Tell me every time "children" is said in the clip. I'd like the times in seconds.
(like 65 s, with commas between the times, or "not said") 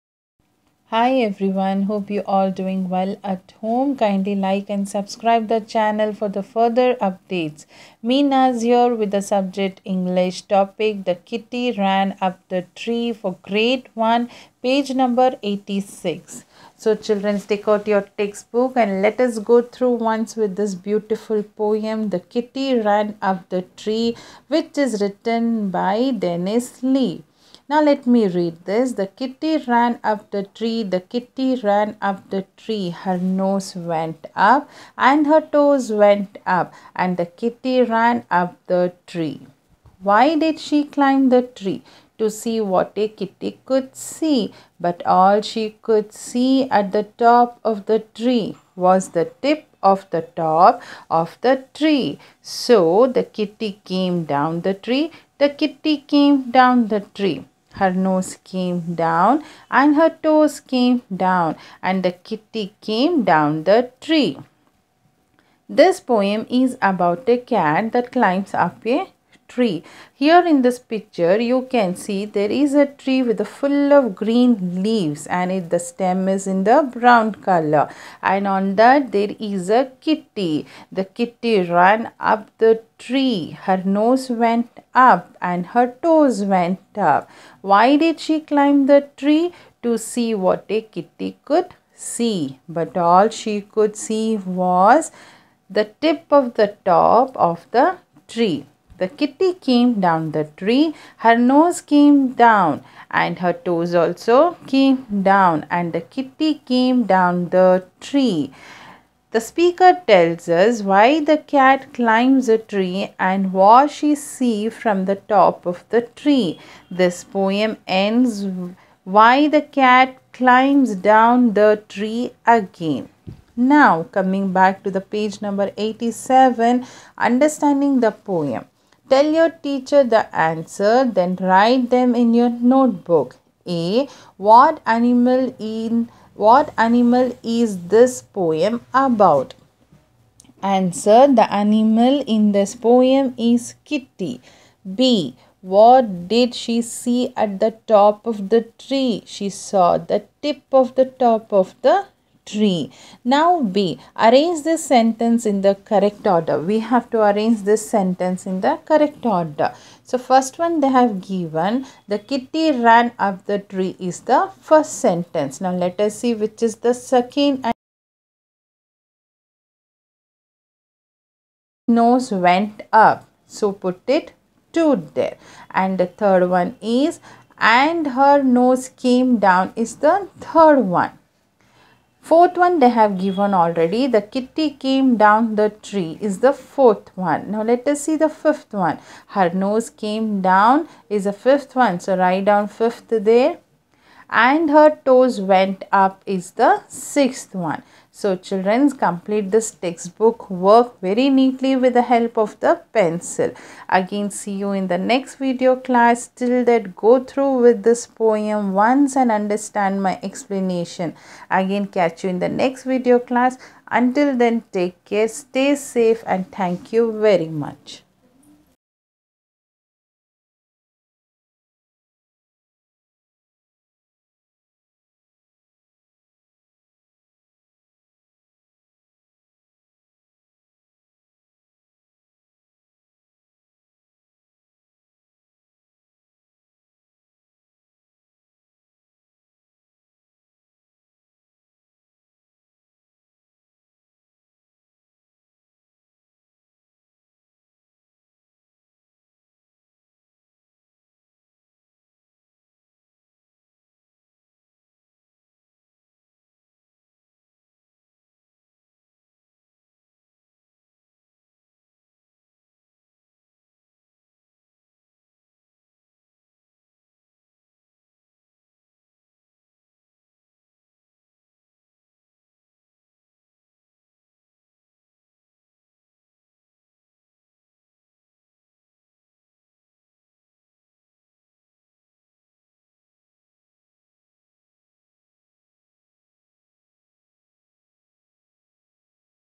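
17 s, 198 s.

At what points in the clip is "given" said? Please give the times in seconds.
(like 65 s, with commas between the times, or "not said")
161 s, 183 s.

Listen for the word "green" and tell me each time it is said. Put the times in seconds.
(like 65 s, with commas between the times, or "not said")
74 s.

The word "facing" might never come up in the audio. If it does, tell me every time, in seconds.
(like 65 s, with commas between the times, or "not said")
not said.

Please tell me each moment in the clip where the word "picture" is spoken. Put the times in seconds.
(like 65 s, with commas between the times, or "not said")
70 s.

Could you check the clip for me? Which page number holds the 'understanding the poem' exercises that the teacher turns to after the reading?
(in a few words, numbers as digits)
87.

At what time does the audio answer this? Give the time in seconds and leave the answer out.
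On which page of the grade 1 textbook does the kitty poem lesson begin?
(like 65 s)
14 s.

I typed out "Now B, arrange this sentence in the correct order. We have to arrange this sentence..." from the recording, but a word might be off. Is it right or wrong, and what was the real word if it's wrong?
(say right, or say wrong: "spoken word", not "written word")
right.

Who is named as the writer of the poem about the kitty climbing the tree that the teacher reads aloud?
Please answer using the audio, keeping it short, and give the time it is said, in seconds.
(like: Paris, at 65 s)
Dennis Lee, at 26 s.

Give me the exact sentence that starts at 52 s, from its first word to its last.
So the kitty came down the tree, the kitty came down the tree.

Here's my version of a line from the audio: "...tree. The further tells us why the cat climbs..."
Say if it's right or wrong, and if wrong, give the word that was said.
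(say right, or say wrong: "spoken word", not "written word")
wrong: "speaker", not "further".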